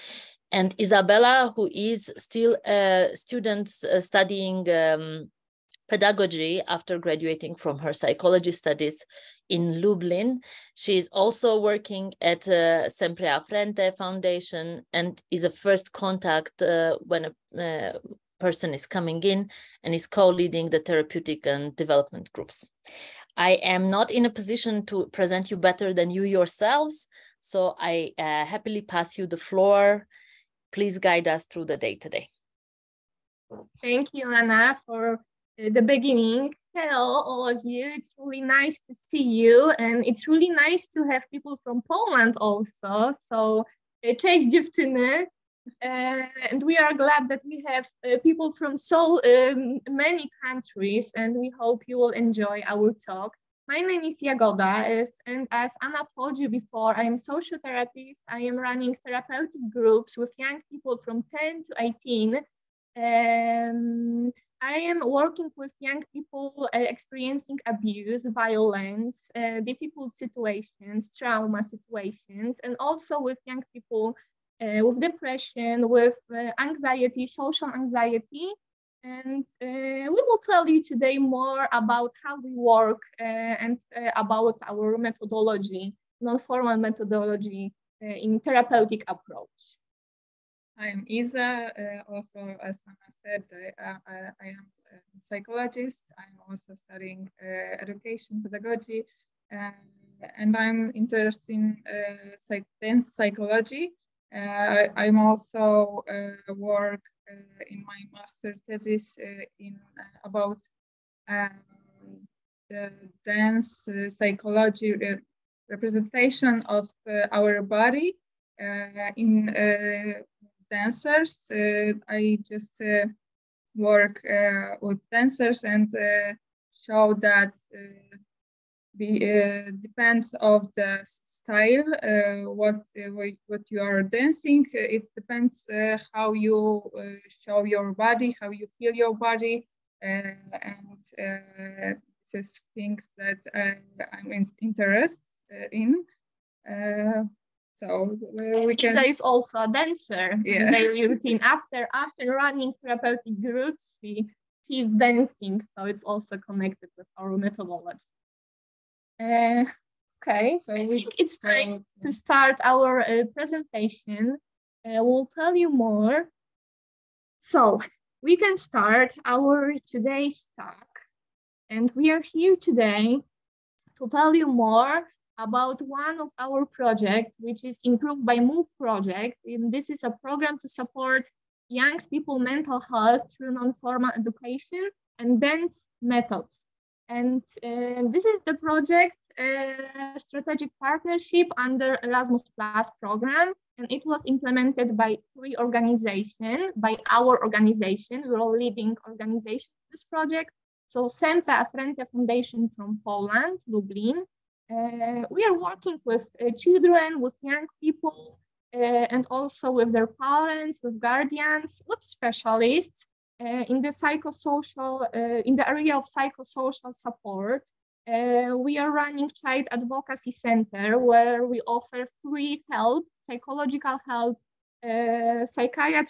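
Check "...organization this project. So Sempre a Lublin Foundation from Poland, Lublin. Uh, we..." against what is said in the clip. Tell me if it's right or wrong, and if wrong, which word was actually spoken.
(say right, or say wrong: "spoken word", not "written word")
wrong: "Frente", not "Lublin".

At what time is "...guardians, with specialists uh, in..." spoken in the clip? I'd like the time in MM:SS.
03:31.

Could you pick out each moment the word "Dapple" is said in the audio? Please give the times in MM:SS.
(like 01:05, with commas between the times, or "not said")
not said.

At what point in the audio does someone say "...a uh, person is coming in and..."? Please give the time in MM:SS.
00:17.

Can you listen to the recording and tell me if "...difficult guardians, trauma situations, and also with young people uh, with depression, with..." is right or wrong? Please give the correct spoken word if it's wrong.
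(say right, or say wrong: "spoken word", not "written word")
wrong: "situations", not "guardians".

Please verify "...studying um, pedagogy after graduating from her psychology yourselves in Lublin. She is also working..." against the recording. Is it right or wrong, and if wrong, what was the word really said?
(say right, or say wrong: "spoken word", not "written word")
wrong: "studies", not "yourselves".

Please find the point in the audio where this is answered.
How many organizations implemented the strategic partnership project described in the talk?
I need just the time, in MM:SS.
03:15.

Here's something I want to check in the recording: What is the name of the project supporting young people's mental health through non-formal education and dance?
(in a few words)
Improved by Move.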